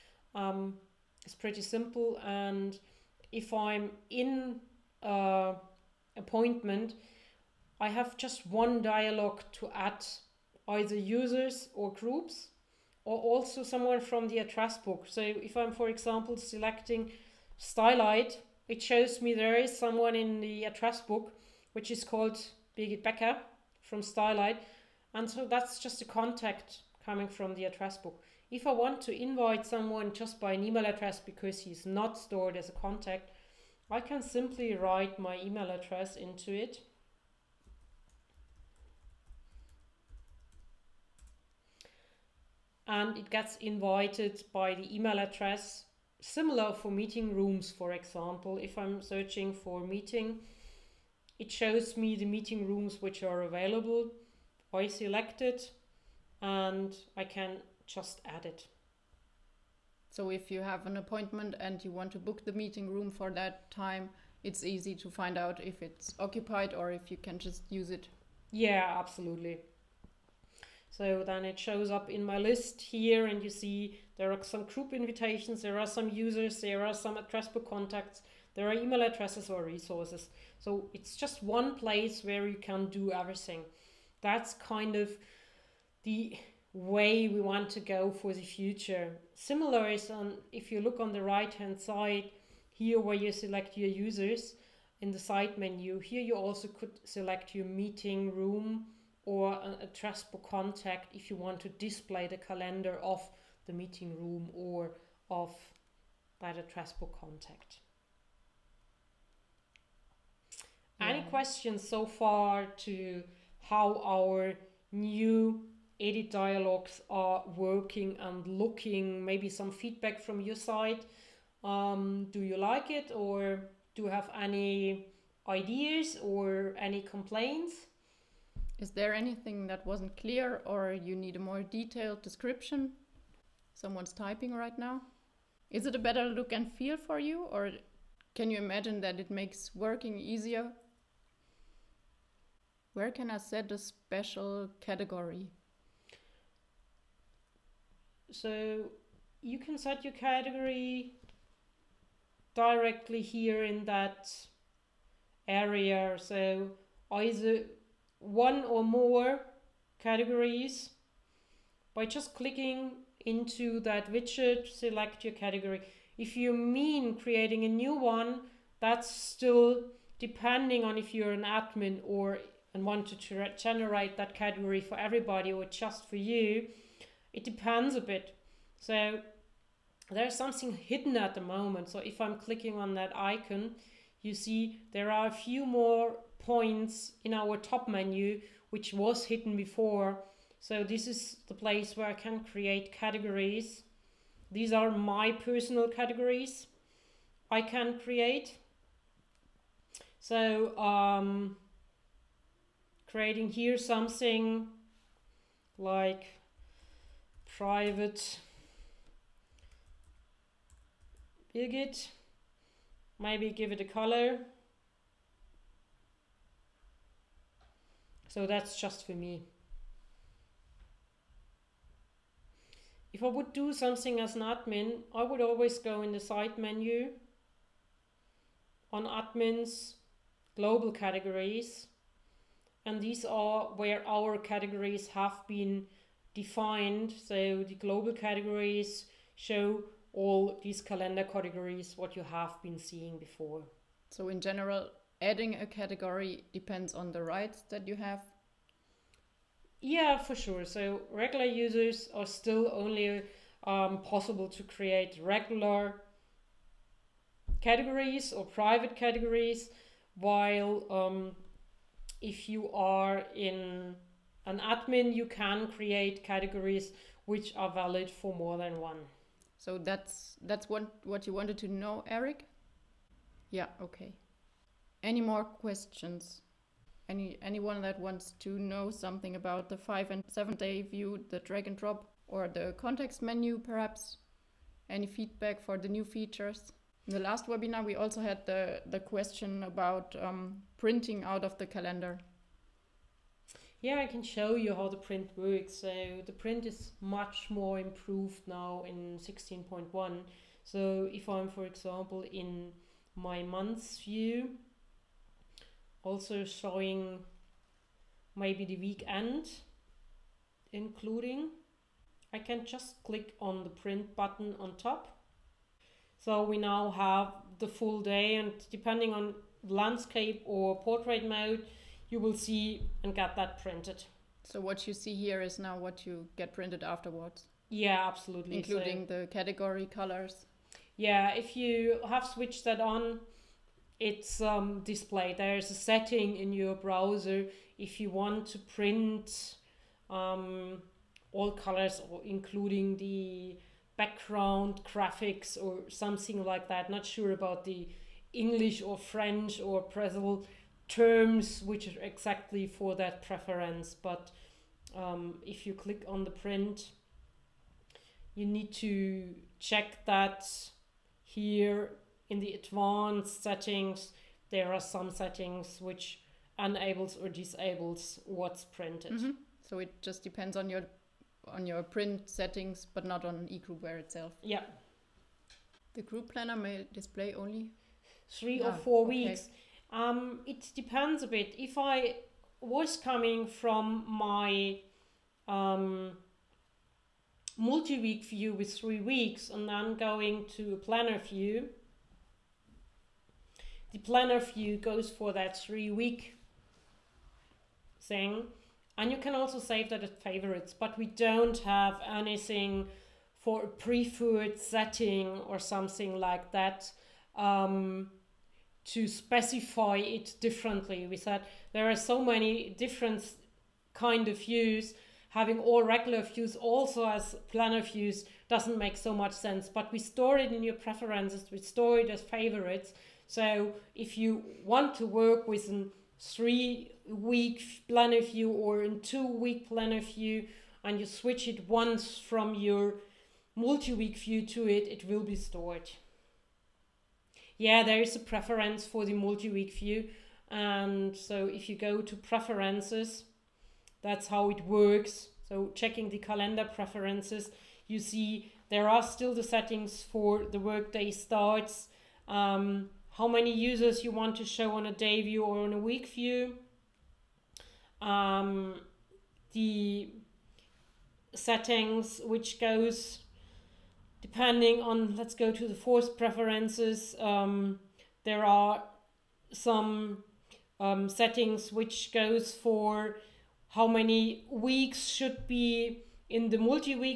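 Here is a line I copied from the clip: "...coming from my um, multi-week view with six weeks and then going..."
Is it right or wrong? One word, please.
wrong.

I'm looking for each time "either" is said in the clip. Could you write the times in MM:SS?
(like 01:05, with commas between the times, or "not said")
00:10, 02:37.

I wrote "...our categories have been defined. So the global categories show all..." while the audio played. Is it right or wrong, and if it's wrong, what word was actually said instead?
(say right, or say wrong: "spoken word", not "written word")
right.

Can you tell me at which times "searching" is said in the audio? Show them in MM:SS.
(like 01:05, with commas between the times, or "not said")
00:49.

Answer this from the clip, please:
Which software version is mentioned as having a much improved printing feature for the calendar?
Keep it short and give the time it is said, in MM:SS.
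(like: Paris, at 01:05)
16.1, at 04:59.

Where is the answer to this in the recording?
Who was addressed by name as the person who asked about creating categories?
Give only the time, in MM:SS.
04:32.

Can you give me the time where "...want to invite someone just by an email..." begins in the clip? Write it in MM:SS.
00:28.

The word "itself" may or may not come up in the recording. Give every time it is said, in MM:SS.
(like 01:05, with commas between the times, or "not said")
06:13.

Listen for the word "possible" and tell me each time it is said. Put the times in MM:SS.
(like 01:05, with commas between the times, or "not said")
04:14.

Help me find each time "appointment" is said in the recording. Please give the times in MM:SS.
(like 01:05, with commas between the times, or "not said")
00:06, 01:00.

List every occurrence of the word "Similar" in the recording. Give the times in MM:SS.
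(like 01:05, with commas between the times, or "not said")
00:46, 01:29.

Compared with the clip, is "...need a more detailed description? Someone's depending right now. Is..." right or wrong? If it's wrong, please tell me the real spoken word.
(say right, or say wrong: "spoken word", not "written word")
wrong: "typing", not "depending".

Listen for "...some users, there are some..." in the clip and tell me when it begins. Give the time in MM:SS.
01:15.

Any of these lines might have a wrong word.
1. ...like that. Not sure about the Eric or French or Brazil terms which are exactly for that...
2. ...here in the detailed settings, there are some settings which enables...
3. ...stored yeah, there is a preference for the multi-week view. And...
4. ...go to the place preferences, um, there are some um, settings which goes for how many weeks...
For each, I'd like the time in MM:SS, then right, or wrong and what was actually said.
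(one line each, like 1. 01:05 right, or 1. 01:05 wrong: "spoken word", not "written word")
1. 05:46 wrong: "English", not "Eric"
2. 06:01 wrong: "advanced", not "detailed"
3. 07:15 right
4. 07:45 wrong: "force", not "place".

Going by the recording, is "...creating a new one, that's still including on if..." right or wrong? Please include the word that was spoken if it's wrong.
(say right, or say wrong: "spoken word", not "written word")
wrong: "depending", not "including".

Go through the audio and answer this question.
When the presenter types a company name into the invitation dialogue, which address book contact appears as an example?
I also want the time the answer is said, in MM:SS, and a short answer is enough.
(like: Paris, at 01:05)
Birgit Becker, at 00:22.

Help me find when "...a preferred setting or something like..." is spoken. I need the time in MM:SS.
06:43.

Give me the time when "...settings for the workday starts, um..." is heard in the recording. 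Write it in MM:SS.
07:29.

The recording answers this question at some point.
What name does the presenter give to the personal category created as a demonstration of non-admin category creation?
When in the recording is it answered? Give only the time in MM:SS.
03:27.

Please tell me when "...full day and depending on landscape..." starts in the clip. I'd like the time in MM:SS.
05:17.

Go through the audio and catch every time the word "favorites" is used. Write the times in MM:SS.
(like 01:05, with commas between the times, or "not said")
06:40, 07:02.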